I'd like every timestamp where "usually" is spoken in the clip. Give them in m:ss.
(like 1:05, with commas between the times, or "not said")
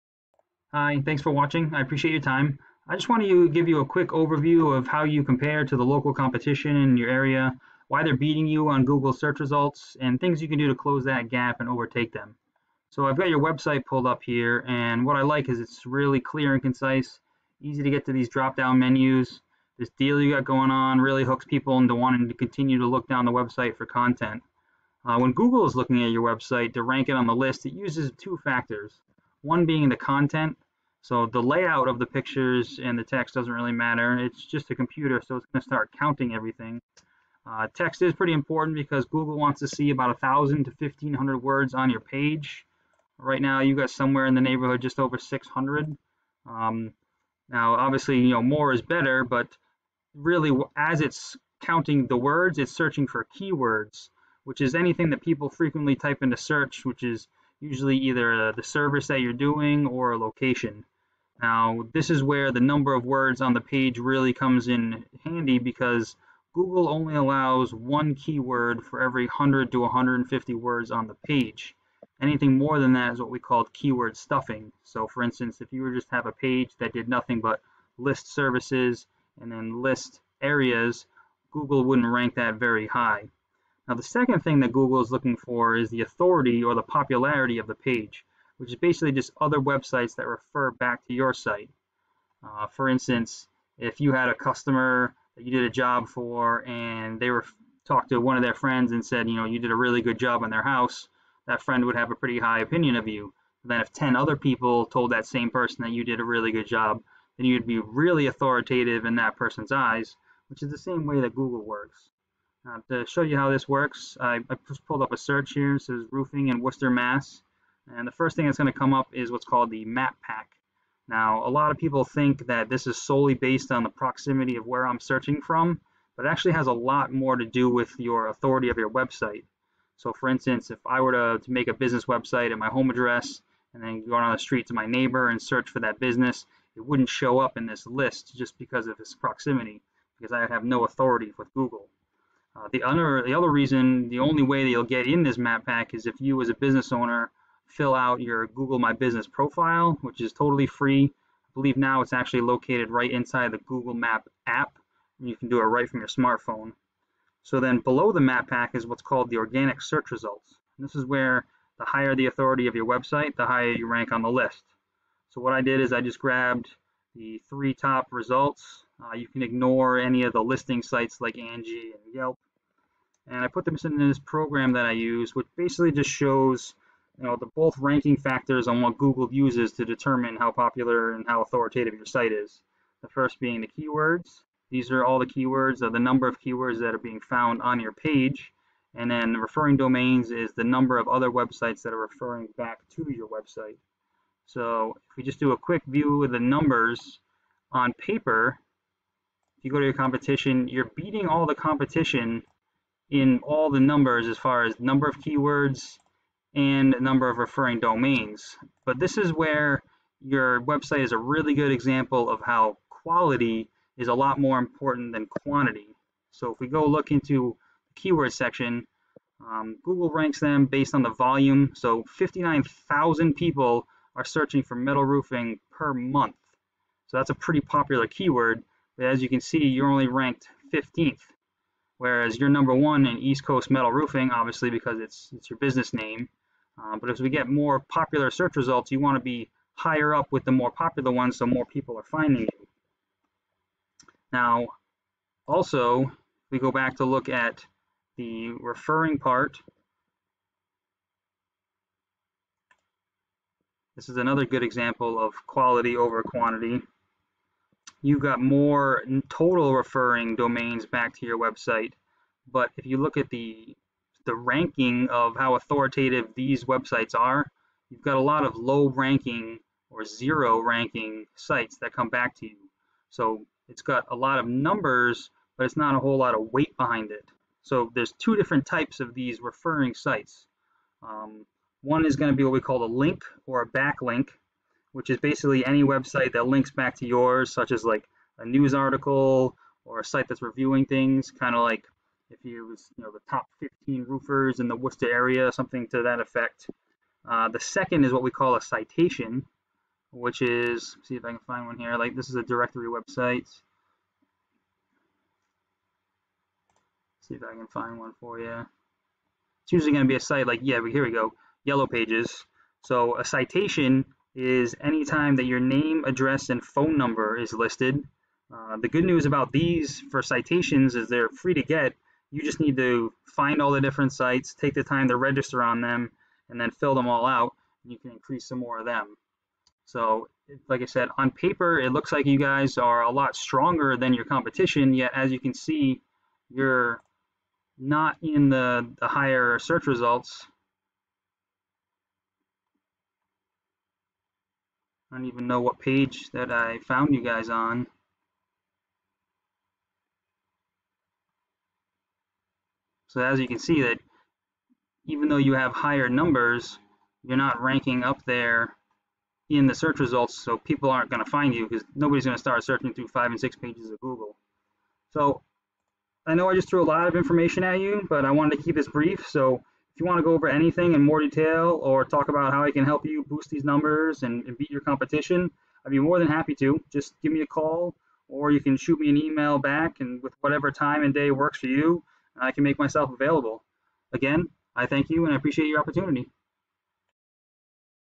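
0:57, 5:09.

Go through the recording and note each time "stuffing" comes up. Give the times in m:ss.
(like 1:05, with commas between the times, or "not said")
1:14.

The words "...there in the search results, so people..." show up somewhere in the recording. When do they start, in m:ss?
5:58.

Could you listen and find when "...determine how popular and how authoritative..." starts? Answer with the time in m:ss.
2:59.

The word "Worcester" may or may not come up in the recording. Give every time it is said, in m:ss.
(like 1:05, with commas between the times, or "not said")
1:56, 4:54.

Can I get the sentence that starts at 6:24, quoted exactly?
Again, I thank you and I appreciate your opportunity.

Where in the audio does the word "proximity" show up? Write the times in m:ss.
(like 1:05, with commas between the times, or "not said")
2:03, 2:19.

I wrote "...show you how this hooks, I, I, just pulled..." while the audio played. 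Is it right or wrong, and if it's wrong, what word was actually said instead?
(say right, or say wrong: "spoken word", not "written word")
wrong: "works", not "hooks".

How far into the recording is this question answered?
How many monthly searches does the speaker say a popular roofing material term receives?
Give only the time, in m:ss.
3:42.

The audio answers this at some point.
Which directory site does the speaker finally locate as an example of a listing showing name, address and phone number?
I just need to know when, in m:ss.
5:11.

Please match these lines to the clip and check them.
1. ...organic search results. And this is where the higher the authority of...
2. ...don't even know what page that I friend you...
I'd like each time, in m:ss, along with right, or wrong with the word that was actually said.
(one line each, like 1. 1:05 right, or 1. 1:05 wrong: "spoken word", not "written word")
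1. 2:39 right
2. 5:45 wrong: "found", not "friend".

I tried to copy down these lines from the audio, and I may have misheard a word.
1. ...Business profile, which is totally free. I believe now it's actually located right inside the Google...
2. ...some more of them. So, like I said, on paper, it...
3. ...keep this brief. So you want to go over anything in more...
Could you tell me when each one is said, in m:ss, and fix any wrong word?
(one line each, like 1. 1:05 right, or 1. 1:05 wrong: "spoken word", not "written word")
1. 2:28 right
2. 5:28 right
3. 6:08 right.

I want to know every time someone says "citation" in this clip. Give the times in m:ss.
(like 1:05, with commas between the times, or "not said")
4:58, 5:13, 5:20.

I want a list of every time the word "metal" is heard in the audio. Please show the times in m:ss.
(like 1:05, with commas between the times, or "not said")
3:44, 3:53.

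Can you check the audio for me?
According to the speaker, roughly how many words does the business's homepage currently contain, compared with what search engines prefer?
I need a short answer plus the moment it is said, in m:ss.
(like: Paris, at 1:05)
just over 600, at 0:44.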